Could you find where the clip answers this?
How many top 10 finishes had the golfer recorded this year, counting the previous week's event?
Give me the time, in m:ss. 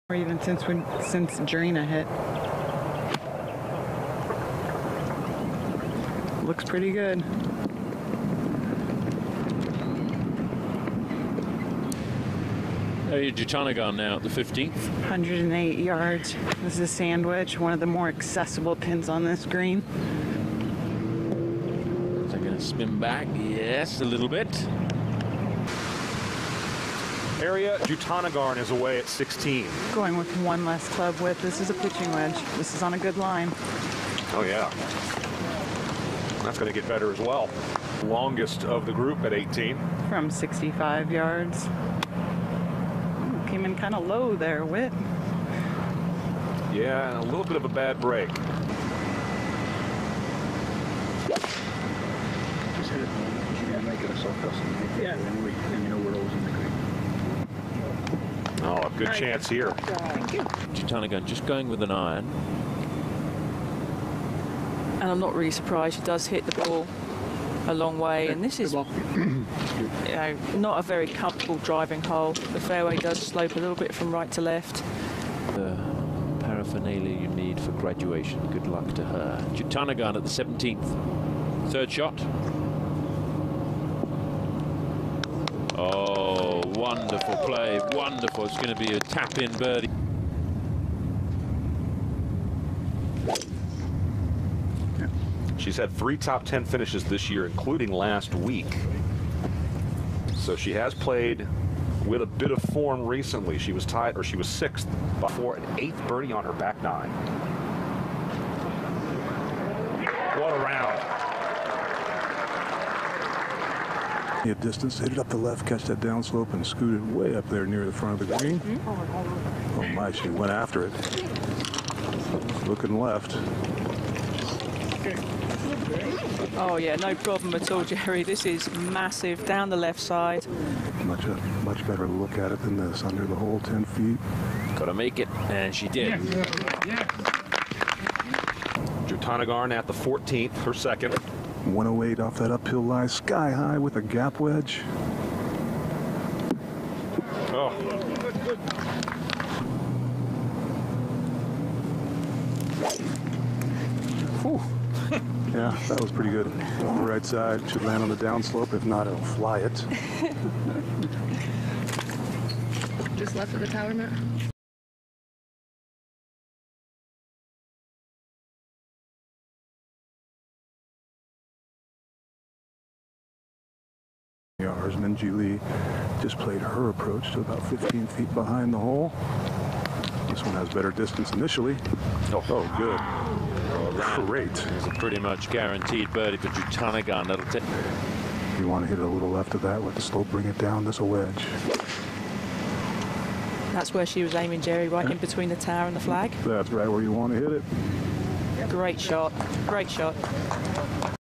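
1:35.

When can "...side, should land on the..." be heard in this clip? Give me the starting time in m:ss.
2:37.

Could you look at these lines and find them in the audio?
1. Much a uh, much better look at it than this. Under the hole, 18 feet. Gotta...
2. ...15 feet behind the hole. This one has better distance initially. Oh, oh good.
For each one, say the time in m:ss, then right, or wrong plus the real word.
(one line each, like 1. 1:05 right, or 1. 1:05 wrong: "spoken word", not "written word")
1. 2:11 wrong: "10", not "18"
2. 2:57 right.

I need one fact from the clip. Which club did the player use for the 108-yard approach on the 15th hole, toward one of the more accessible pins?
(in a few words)
sand wedge.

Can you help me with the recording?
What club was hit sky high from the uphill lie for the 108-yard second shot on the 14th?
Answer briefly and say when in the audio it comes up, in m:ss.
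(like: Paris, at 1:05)
gap wedge, at 2:24.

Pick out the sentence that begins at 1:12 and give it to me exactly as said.
The fairway does slope a little bit from right to left.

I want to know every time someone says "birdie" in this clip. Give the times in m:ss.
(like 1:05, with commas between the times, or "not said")
1:29, 1:46, 3:06.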